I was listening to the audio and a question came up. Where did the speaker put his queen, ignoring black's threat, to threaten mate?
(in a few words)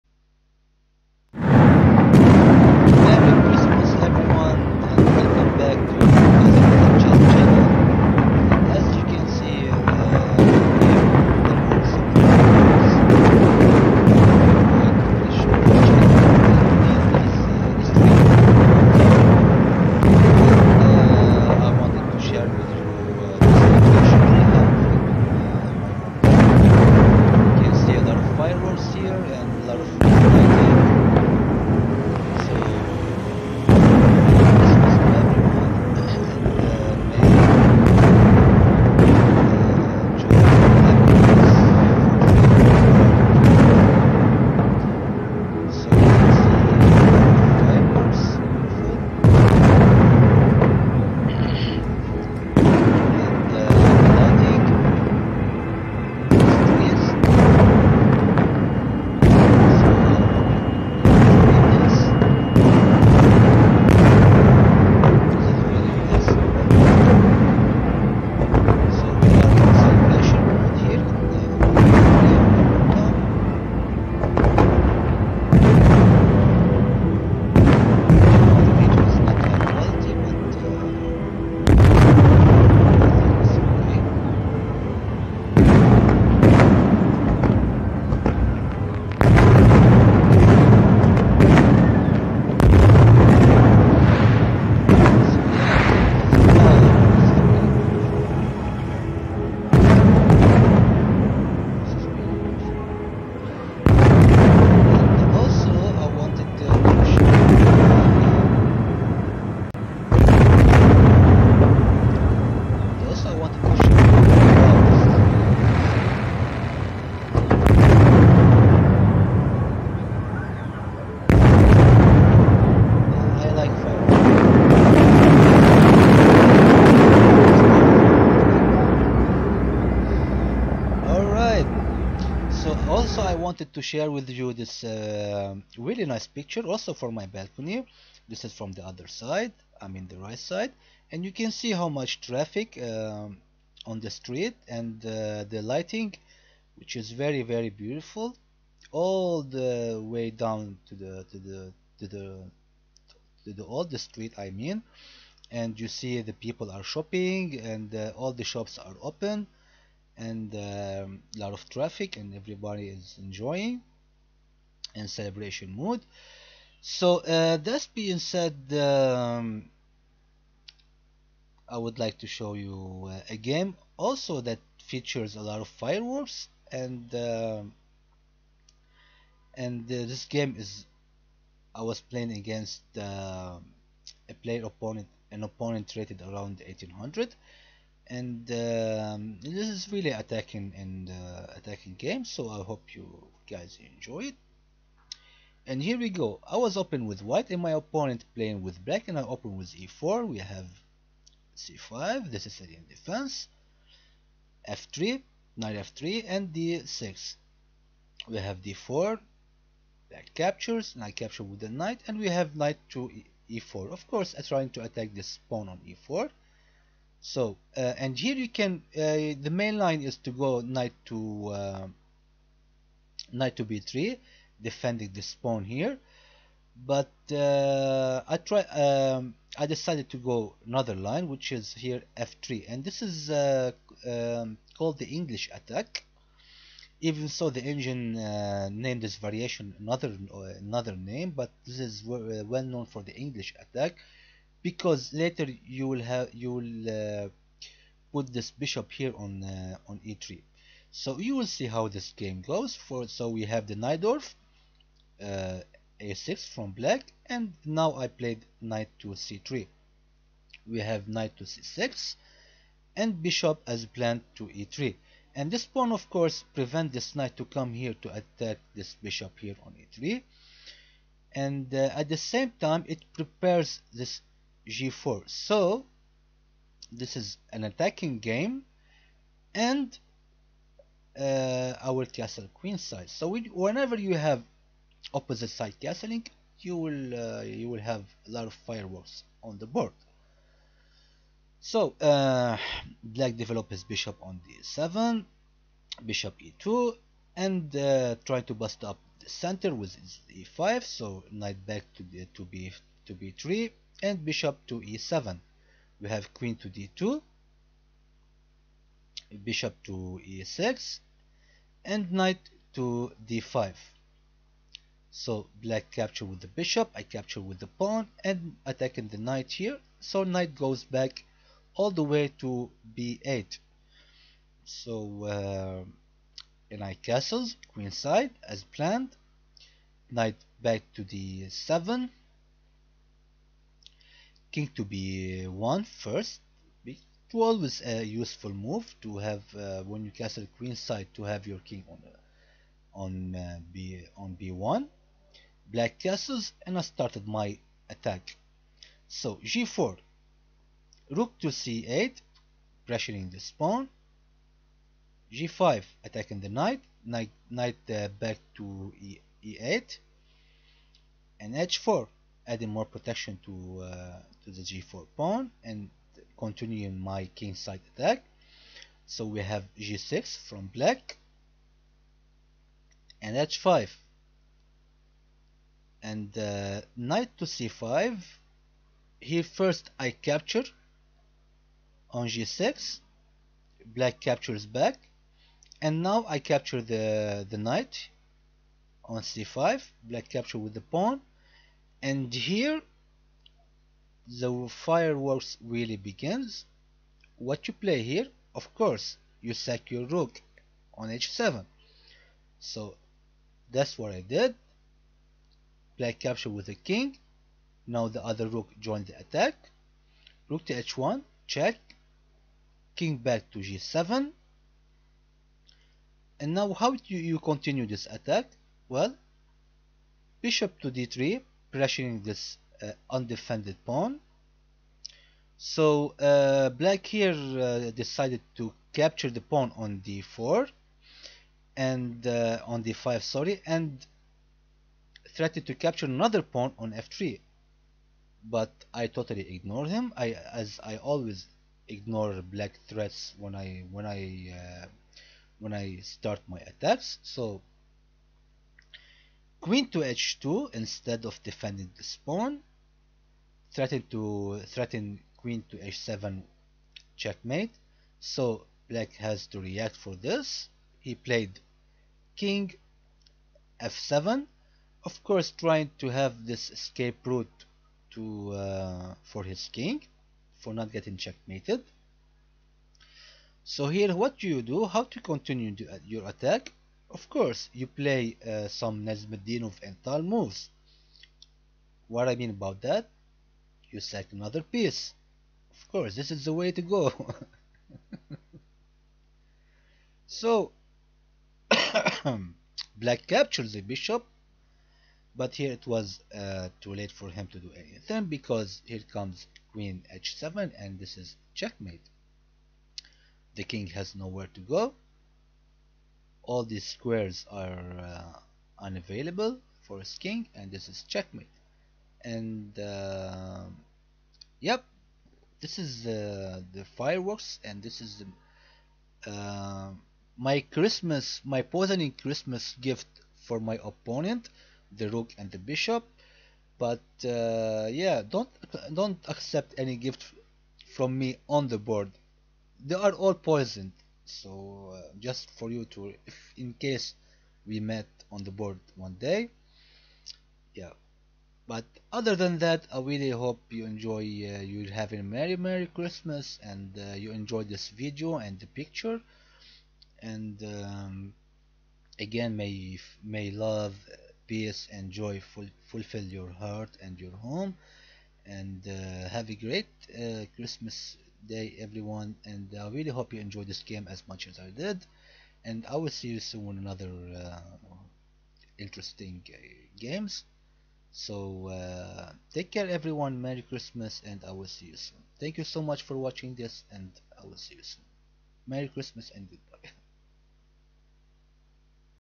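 h2.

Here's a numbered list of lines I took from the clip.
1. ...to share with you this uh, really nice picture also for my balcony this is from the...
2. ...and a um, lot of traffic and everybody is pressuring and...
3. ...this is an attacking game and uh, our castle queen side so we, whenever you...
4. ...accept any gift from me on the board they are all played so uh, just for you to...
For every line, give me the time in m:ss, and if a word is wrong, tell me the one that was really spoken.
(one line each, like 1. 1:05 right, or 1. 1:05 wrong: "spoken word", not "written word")
1. 2:13 right
2. 2:40 wrong: "enjoying", not "pressuring"
3. 4:36 right
4. 8:49 wrong: "poisoned", not "played".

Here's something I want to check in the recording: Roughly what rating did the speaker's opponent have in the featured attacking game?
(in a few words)
1800.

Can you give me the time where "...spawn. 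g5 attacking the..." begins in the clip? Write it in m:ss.
5:53.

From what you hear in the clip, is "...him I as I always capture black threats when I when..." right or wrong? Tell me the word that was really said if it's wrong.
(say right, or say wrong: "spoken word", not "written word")
wrong: "ignore", not "capture".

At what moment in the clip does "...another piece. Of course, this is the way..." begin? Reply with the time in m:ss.
8:04.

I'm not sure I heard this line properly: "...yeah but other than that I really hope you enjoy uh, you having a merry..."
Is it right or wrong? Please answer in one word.
right.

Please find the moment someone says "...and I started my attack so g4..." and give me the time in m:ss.
5:46.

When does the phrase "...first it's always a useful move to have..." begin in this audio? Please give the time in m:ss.
5:35.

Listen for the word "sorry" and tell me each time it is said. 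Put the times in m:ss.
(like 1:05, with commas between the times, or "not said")
7:13.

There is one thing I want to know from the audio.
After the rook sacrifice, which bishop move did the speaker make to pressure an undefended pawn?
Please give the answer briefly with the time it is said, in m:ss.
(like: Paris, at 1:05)
Bishop to d3, at 7:00.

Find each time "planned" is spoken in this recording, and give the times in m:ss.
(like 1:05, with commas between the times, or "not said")
4:23, 5:28.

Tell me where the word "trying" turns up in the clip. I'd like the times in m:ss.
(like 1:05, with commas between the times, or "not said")
3:34, 7:45.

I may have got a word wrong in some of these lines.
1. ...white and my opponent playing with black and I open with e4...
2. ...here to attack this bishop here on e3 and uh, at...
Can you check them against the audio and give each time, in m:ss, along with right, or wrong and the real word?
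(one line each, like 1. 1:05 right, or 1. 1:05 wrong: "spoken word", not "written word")
1. 3:17 right
2. 4:27 right.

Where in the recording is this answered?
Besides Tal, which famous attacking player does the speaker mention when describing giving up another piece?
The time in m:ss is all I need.
7:59.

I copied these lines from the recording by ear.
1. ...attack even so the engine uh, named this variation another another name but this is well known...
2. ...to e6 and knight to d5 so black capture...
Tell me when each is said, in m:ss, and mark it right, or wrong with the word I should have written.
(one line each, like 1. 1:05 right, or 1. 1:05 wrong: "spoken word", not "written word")
1. 3:55 right
2. 5:09 right.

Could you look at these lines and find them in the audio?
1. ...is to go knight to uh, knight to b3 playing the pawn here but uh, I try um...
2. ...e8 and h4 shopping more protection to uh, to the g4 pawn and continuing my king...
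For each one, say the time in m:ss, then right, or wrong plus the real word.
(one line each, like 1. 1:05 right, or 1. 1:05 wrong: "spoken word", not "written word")
1. 3:40 wrong: "defending", not "playing"
2. 5:59 wrong: "adding", not "shopping".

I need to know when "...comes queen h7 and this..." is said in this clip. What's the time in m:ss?
8:19.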